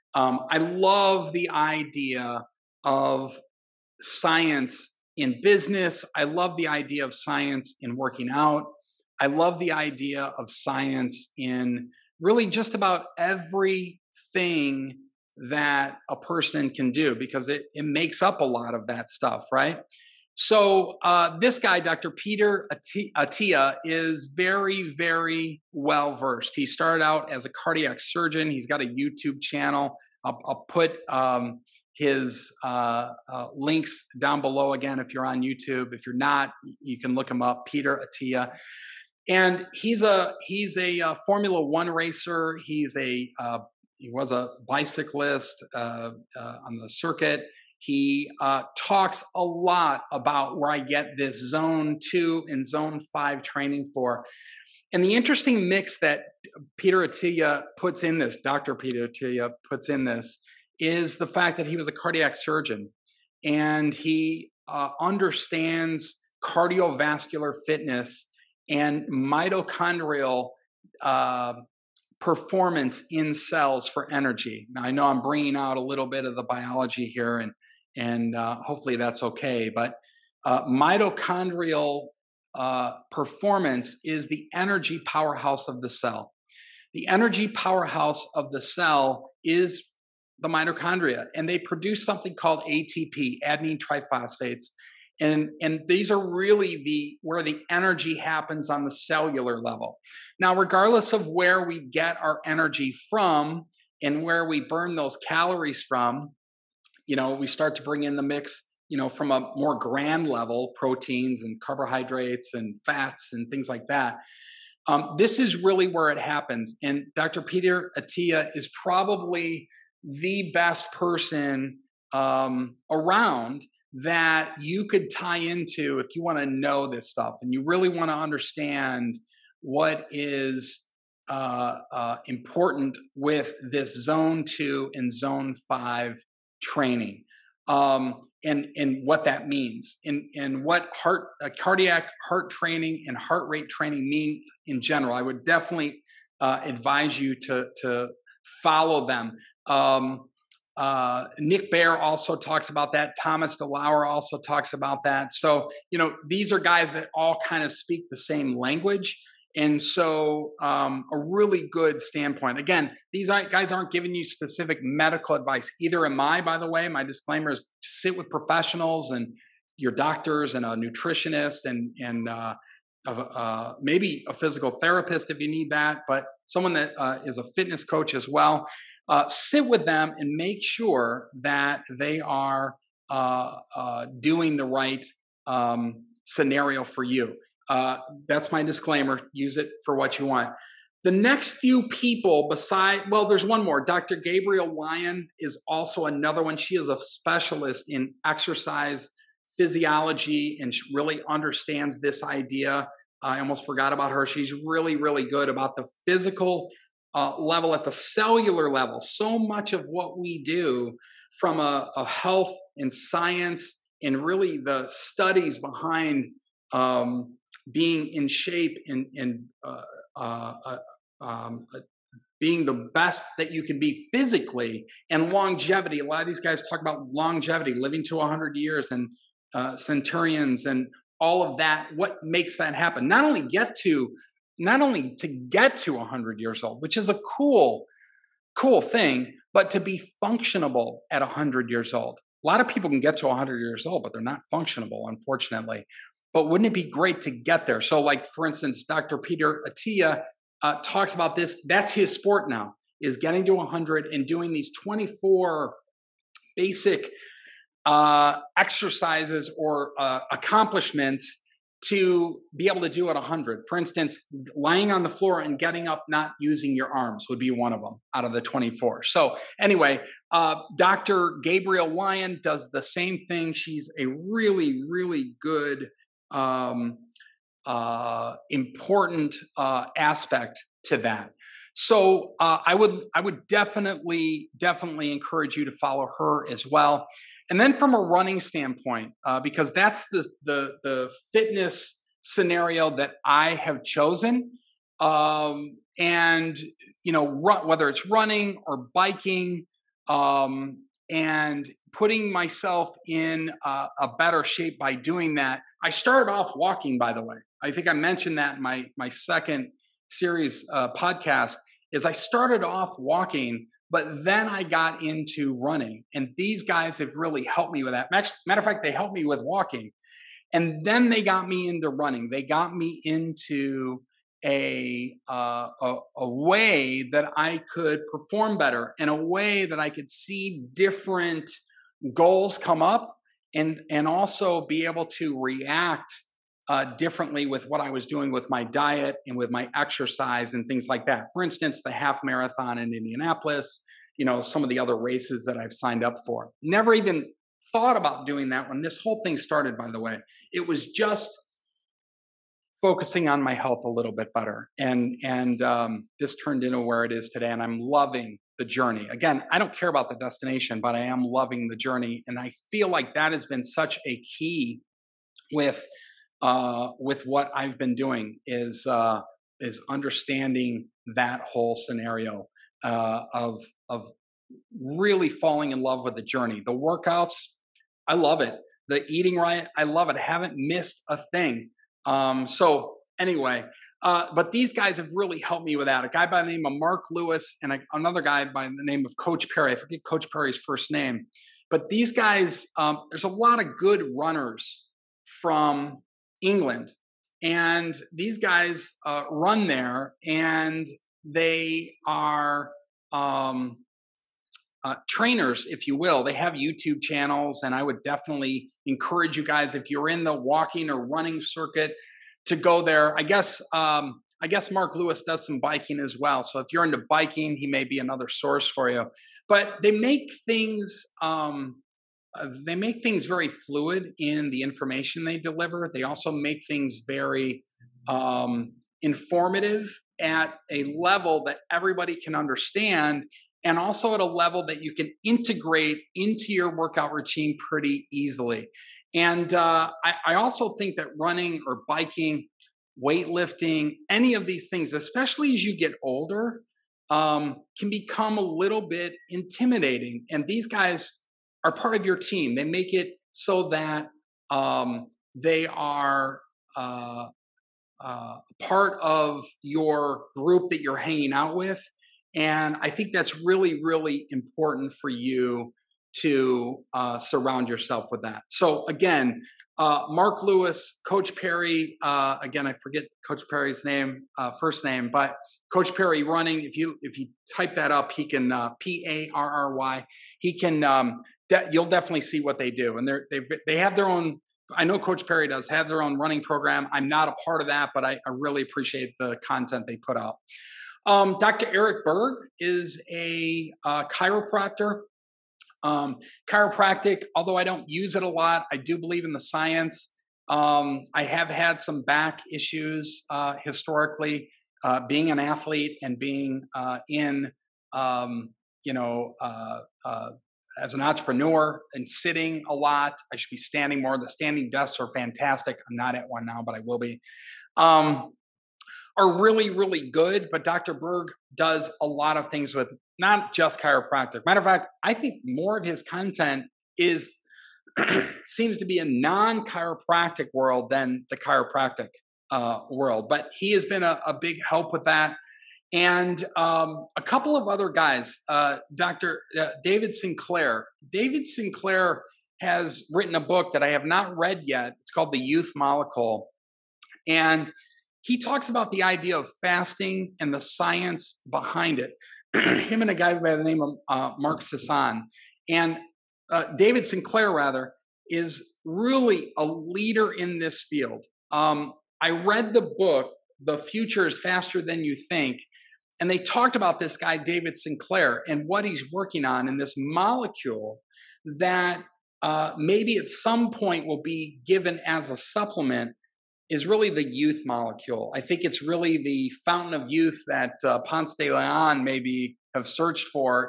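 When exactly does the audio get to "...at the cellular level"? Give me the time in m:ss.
3:27.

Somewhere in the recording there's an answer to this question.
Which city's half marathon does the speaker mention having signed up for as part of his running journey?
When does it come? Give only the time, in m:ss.
5:42.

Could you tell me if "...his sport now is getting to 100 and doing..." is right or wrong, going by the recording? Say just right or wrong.
right.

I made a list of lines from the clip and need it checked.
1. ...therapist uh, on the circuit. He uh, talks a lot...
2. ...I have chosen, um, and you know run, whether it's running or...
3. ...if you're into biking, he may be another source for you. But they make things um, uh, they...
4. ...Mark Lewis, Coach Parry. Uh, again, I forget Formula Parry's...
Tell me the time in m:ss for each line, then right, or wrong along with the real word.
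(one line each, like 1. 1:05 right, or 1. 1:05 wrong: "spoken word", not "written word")
1. 0:44 wrong: "bicyclist", not "therapist"
2. 4:53 right
3. 6:56 right
4. 7:50 wrong: "Coach", not "Formula".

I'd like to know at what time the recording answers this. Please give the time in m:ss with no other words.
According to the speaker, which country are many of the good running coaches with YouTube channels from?
6:36.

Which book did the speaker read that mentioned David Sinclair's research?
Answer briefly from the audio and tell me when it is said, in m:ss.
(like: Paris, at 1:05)
The Future is Faster Than You Think, at 9:23.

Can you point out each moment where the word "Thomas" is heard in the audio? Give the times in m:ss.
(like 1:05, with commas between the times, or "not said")
2:33.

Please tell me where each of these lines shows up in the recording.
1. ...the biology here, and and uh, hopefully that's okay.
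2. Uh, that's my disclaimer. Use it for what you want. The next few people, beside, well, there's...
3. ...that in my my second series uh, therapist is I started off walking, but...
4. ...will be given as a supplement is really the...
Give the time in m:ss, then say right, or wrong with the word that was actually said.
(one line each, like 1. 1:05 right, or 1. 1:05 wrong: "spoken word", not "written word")
1. 1:16 right
2. 3:07 right
3. 5:08 wrong: "podcast", not "therapist"
4. 9:34 right.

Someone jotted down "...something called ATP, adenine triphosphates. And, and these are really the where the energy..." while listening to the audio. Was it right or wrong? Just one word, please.
right.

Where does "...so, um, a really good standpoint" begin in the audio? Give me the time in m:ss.
2:39.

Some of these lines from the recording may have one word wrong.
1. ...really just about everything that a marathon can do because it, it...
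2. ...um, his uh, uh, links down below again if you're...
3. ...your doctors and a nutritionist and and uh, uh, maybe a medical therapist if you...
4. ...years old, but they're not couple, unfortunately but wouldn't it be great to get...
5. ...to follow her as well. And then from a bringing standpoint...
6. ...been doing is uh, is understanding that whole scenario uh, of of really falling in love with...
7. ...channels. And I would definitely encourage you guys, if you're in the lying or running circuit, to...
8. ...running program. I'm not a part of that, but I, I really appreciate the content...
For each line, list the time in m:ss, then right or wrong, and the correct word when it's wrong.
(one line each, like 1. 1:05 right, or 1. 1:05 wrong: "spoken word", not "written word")
1. 0:12 wrong: "person", not "marathon"
2. 0:31 right
3. 2:49 wrong: "physical", not "medical"
4. 4:03 wrong: "functionable", not "couple"
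5. 4:45 wrong: "running", not "bringing"
6. 6:07 right
7. 6:47 wrong: "walking", not "lying"
8. 8:06 right.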